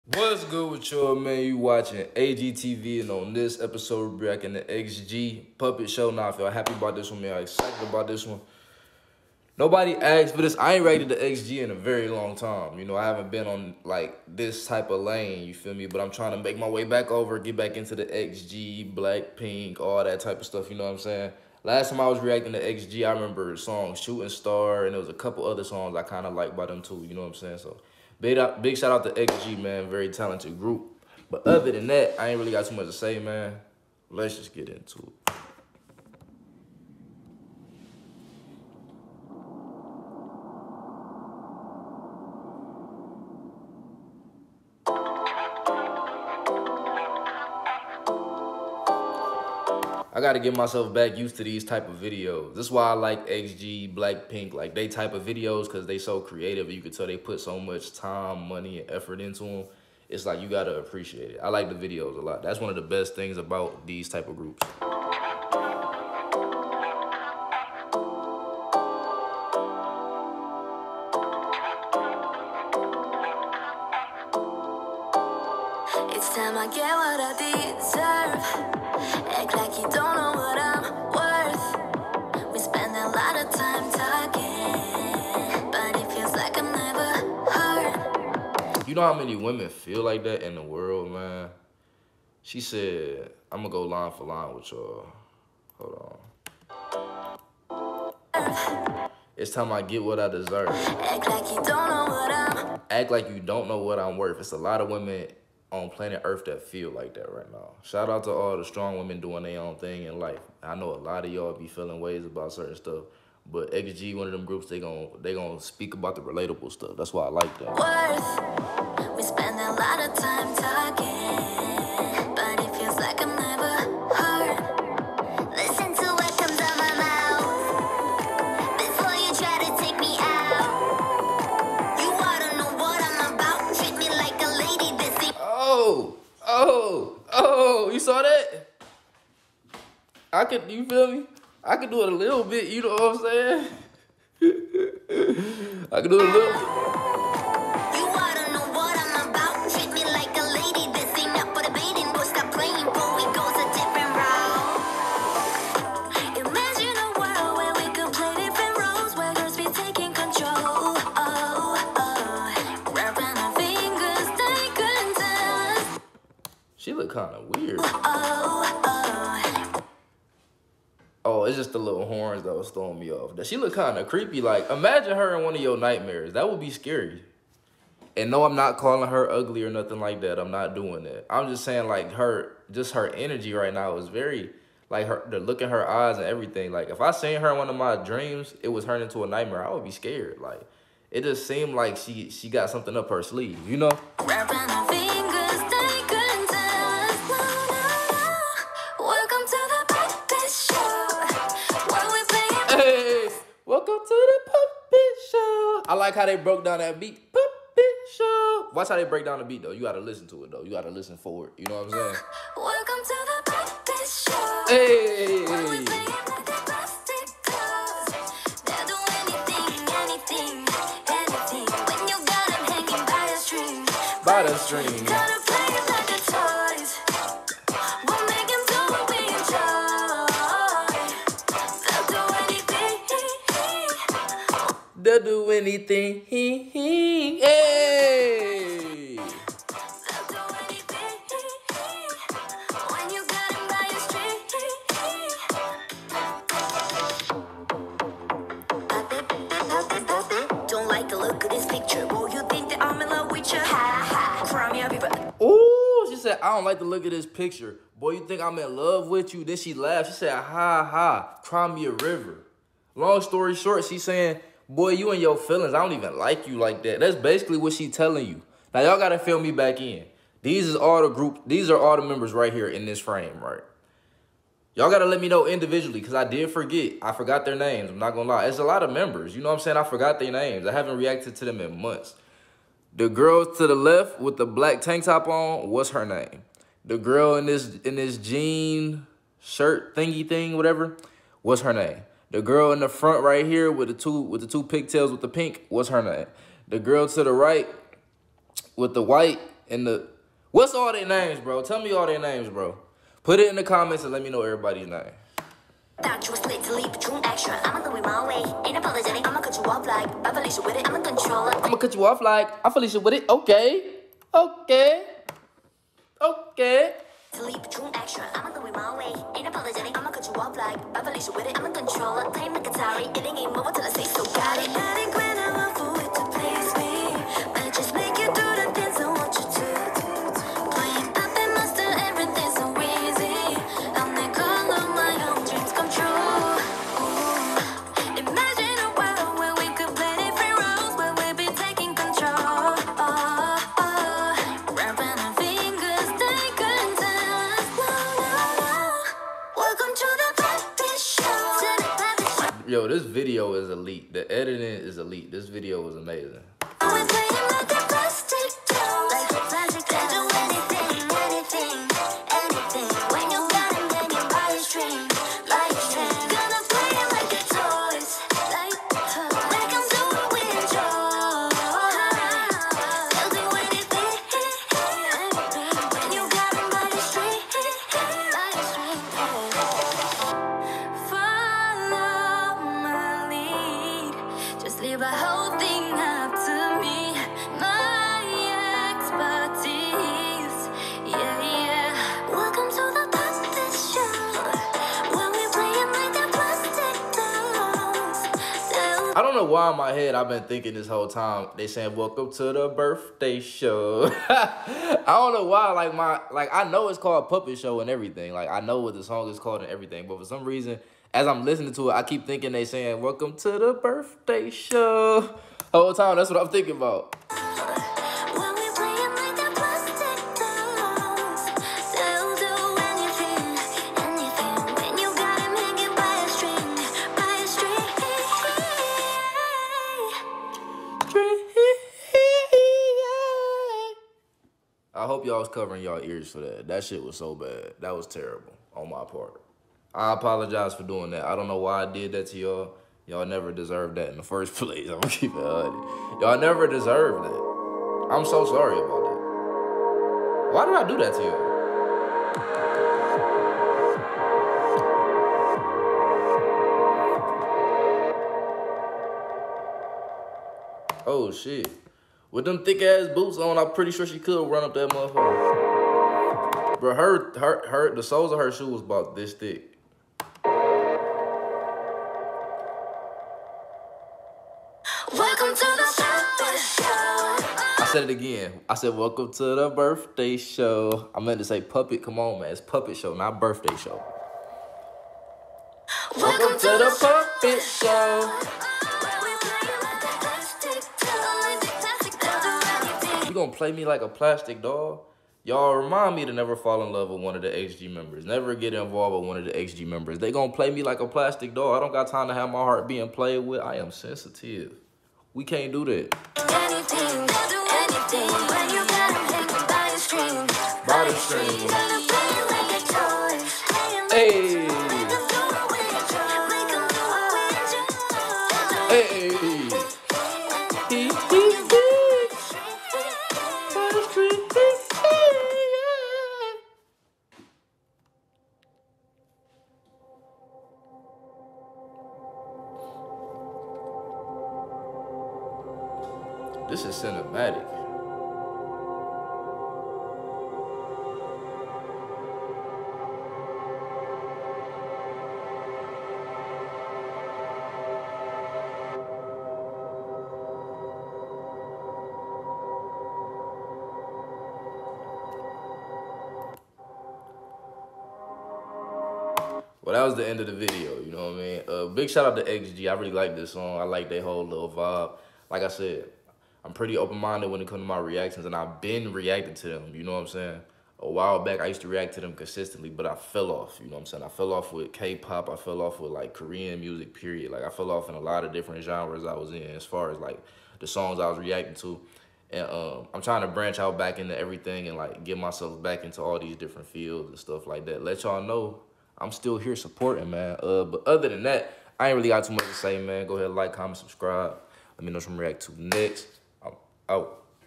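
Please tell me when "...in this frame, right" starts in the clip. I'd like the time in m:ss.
4:32.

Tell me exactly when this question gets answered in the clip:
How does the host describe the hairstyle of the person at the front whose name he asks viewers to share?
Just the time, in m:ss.
4:54.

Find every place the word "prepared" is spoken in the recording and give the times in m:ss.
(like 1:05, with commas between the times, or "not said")
not said.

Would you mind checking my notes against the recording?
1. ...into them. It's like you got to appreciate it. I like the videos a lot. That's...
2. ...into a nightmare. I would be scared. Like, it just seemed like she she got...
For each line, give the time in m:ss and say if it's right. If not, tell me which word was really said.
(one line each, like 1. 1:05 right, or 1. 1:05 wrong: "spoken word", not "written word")
1. 0:59 right
2. 3:08 right.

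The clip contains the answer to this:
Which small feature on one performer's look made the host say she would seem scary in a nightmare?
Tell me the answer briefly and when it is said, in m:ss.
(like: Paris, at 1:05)
Little horns, at 2:51.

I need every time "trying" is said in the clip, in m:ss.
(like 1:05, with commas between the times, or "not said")
0:16, 9:43.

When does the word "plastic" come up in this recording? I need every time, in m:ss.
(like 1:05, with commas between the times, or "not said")
8:14, 8:21.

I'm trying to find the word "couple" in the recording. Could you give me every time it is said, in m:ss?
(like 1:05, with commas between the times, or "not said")
0:25.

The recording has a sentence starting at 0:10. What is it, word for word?
I ain't rated the XG in a very long time.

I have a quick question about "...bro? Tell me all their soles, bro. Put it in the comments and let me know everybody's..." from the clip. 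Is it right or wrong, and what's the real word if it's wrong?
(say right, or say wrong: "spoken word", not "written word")
wrong: "names", not "soles".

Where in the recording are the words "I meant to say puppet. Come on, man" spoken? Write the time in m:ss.
8:01.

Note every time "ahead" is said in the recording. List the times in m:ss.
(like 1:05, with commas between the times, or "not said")
9:53.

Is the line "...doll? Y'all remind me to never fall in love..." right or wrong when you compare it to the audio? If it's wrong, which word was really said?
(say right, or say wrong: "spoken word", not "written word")
right.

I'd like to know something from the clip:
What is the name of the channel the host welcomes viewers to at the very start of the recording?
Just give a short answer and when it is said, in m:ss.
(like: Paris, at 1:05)
AGTV, at 0:02.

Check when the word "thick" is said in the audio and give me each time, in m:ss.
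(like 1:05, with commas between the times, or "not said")
7:42, 7:49.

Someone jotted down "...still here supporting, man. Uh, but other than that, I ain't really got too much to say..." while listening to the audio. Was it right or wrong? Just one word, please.
right.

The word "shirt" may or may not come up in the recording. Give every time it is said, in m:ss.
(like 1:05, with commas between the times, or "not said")
4:49.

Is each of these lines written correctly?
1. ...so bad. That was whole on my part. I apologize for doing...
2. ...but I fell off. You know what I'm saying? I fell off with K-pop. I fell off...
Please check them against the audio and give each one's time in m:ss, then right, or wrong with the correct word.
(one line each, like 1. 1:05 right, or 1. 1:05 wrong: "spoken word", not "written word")
1. 7:17 wrong: "terrible", not "whole"
2. 9:32 right.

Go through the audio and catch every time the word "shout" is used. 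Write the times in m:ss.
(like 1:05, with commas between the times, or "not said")
0:28, 1:47, 9:22.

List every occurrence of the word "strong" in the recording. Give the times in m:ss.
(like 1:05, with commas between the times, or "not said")
1:48.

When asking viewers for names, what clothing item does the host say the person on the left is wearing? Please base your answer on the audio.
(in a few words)
Black tank top.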